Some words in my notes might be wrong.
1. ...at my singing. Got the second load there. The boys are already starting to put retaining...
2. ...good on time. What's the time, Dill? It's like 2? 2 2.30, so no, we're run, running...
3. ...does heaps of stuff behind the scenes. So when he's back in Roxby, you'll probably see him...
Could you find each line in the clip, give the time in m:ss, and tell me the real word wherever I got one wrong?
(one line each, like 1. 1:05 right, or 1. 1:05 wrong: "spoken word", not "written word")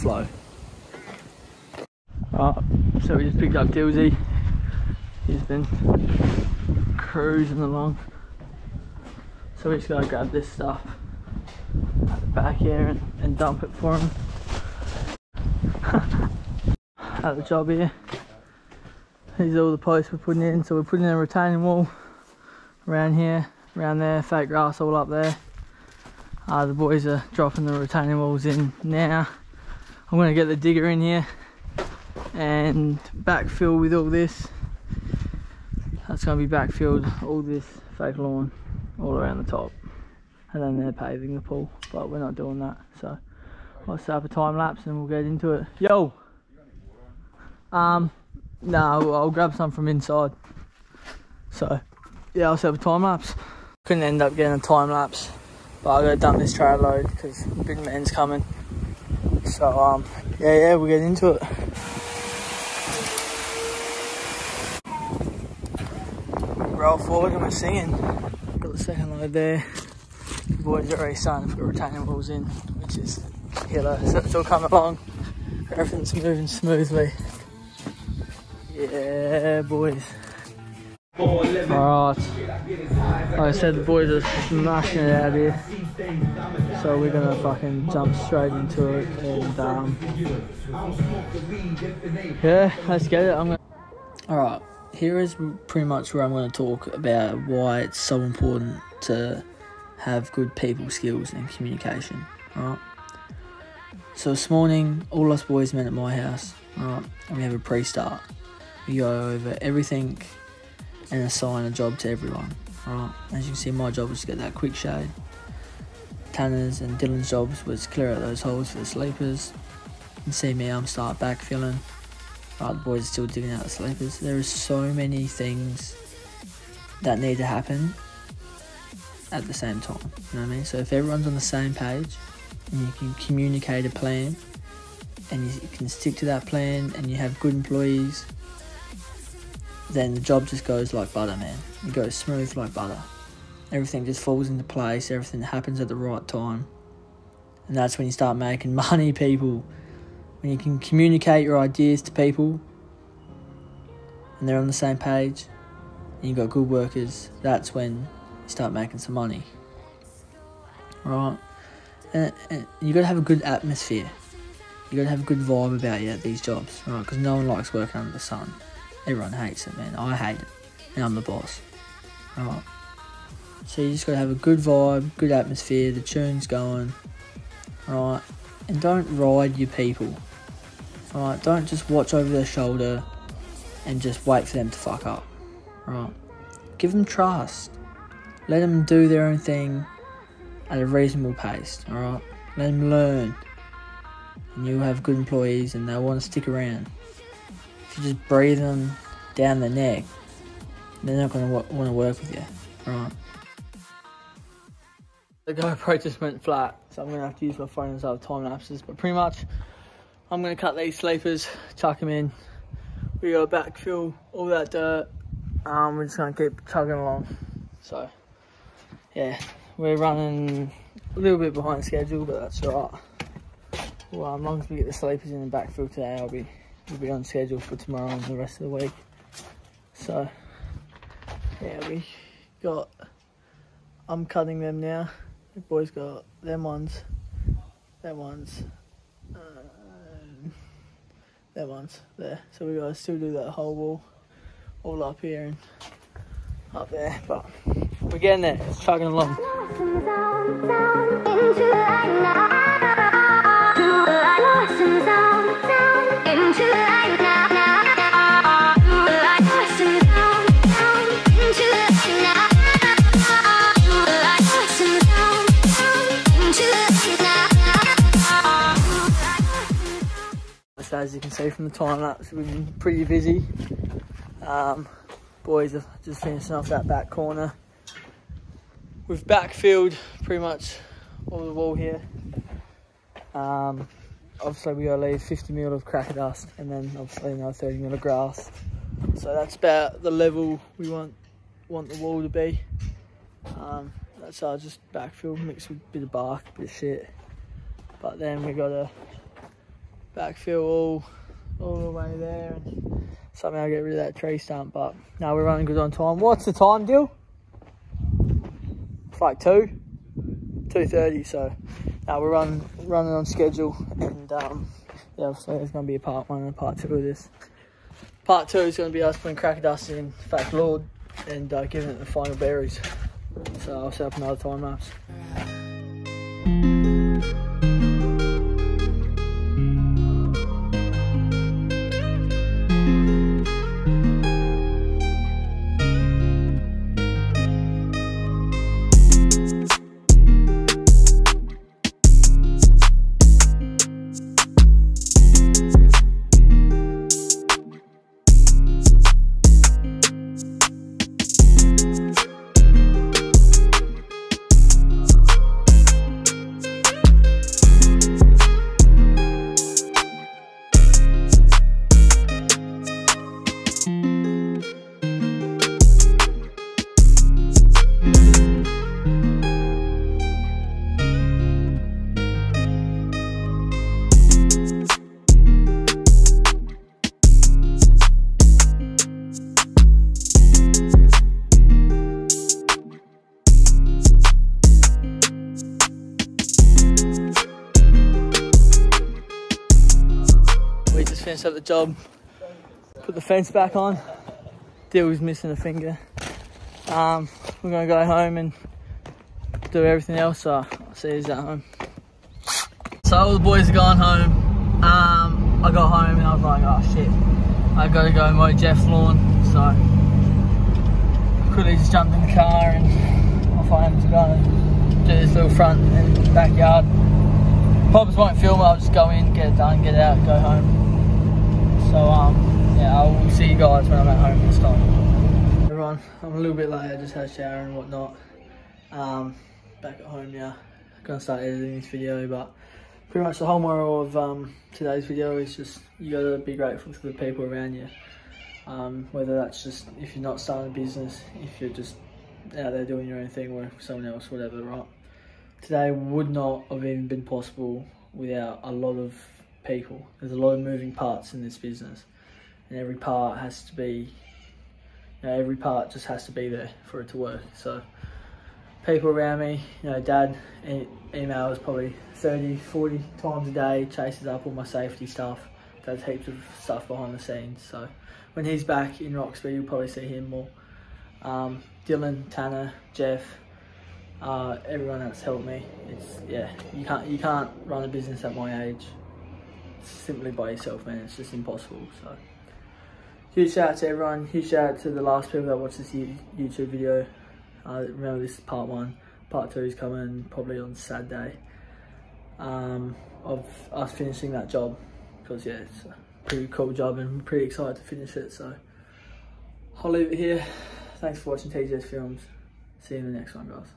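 1. 1:07 right
2. 5:05 right
3. 7:45 right.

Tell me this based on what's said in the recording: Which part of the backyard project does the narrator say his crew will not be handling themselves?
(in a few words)
Paving the pool.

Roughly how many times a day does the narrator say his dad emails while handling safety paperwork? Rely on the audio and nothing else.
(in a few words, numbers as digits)
30 to 40.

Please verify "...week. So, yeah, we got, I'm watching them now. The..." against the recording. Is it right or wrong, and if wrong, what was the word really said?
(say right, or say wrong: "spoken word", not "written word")
wrong: "cutting", not "watching".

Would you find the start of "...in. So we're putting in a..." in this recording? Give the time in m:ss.
0:20.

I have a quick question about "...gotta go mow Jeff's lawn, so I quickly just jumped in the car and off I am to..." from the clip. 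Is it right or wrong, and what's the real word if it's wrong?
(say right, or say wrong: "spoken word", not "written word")
right.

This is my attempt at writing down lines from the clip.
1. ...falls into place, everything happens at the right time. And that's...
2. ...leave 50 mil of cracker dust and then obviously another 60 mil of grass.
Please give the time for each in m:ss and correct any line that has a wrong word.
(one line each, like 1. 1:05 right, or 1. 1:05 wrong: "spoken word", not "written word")
1. 2:24 right
2. 4:44 wrong: "30", not "60".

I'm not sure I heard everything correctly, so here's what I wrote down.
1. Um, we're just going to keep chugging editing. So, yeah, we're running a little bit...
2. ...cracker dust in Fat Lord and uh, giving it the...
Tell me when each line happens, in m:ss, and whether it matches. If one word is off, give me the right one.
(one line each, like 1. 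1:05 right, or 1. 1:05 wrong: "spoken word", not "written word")
1. 3:35 wrong: "along", not "editing"
2. 5:19 right.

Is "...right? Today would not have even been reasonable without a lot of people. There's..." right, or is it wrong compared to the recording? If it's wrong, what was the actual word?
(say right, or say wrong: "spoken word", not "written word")
wrong: "possible", not "reasonable".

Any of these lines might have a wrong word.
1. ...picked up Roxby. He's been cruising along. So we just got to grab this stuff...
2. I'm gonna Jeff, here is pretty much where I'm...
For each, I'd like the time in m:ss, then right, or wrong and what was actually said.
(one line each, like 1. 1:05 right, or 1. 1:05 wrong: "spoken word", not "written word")
1. 0:03 wrong: "Dilsey", not "Roxby"
2. 1:33 wrong: "Alright", not "Jeff".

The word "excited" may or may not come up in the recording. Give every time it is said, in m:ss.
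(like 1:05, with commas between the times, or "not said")
8:17.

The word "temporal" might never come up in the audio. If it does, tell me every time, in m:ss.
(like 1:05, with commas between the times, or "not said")
not said.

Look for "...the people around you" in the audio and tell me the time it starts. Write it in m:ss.
7:17.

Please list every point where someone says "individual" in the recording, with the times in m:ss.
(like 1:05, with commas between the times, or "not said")
not said.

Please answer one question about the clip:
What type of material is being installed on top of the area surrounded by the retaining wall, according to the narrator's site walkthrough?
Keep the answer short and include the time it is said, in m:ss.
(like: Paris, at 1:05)
Fake grass, at 0:24.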